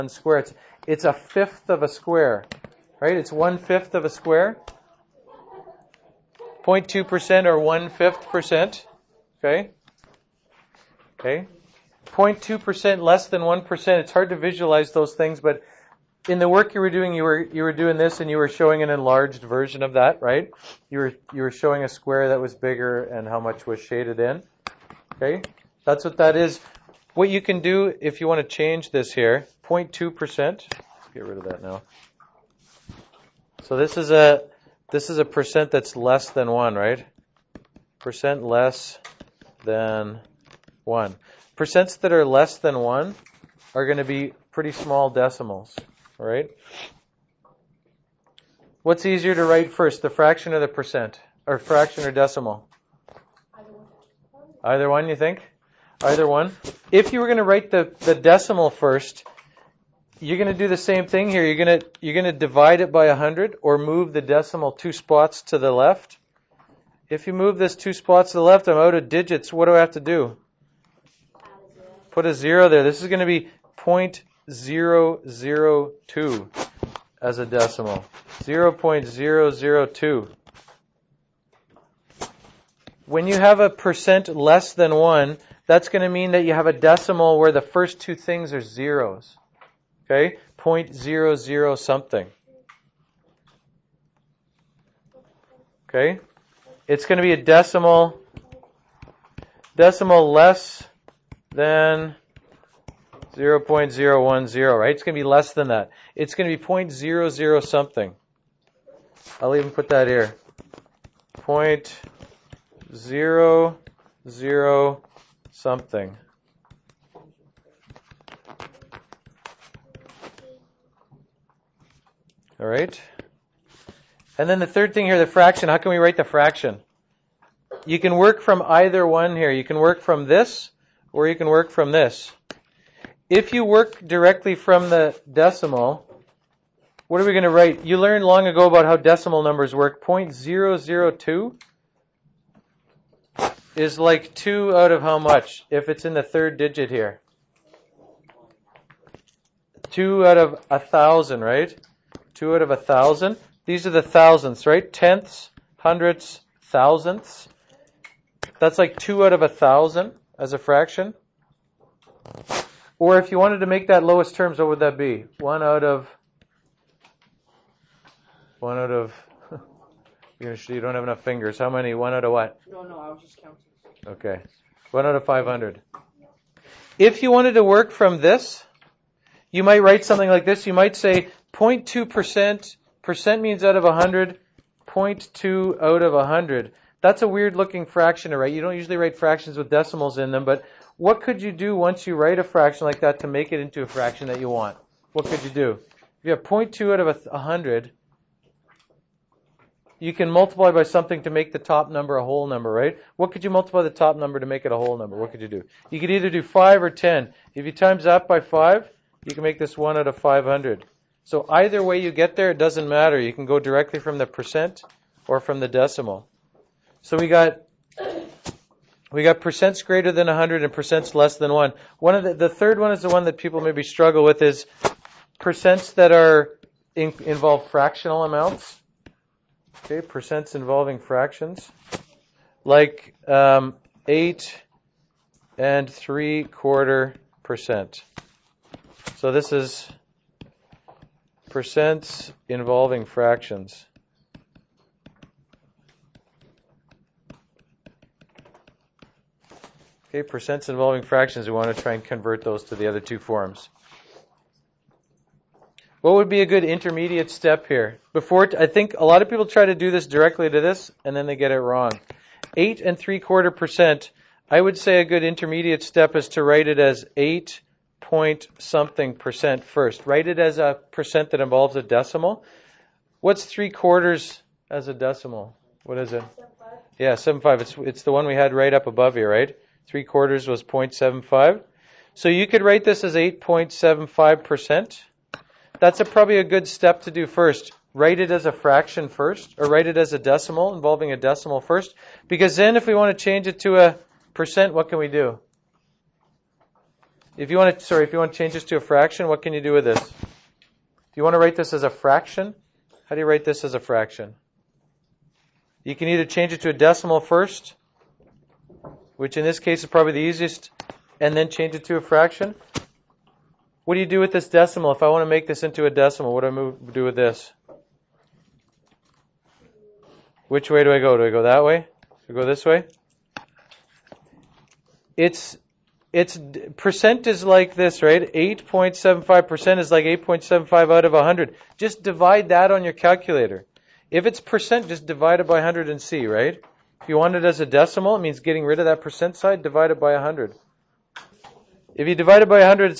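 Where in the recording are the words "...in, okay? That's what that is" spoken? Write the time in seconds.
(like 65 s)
24 s.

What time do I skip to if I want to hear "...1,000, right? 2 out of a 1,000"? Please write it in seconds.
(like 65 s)
150 s.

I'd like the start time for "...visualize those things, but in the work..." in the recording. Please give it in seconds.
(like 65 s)
14 s.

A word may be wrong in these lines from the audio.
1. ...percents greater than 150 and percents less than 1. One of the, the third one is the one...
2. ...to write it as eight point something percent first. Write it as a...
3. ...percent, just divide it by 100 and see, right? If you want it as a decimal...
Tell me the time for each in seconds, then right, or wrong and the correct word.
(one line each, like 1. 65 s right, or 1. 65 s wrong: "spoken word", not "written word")
1. 219 s wrong: "100", not "150"
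2. 266 s right
3. 334 s right.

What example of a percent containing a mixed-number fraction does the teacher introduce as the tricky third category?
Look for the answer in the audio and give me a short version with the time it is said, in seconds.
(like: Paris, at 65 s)
8 and 3/4 percent, at 234 s.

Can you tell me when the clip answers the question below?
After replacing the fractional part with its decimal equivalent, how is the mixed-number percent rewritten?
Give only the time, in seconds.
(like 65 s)
283 s.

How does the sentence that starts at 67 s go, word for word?
If you move this two spots to the left, I'm out of digits.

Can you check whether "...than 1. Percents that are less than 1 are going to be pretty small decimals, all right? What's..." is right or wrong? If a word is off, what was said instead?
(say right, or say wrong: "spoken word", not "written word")
right.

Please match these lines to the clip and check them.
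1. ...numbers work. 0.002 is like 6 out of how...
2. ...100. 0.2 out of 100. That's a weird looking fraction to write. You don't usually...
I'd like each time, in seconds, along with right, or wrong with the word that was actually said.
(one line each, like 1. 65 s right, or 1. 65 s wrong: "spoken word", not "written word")
1. 139 s wrong: "2", not "6"
2. 183 s right.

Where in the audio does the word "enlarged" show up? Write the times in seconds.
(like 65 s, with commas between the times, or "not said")
18 s.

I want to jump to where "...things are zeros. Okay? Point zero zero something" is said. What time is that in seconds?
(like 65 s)
88 s.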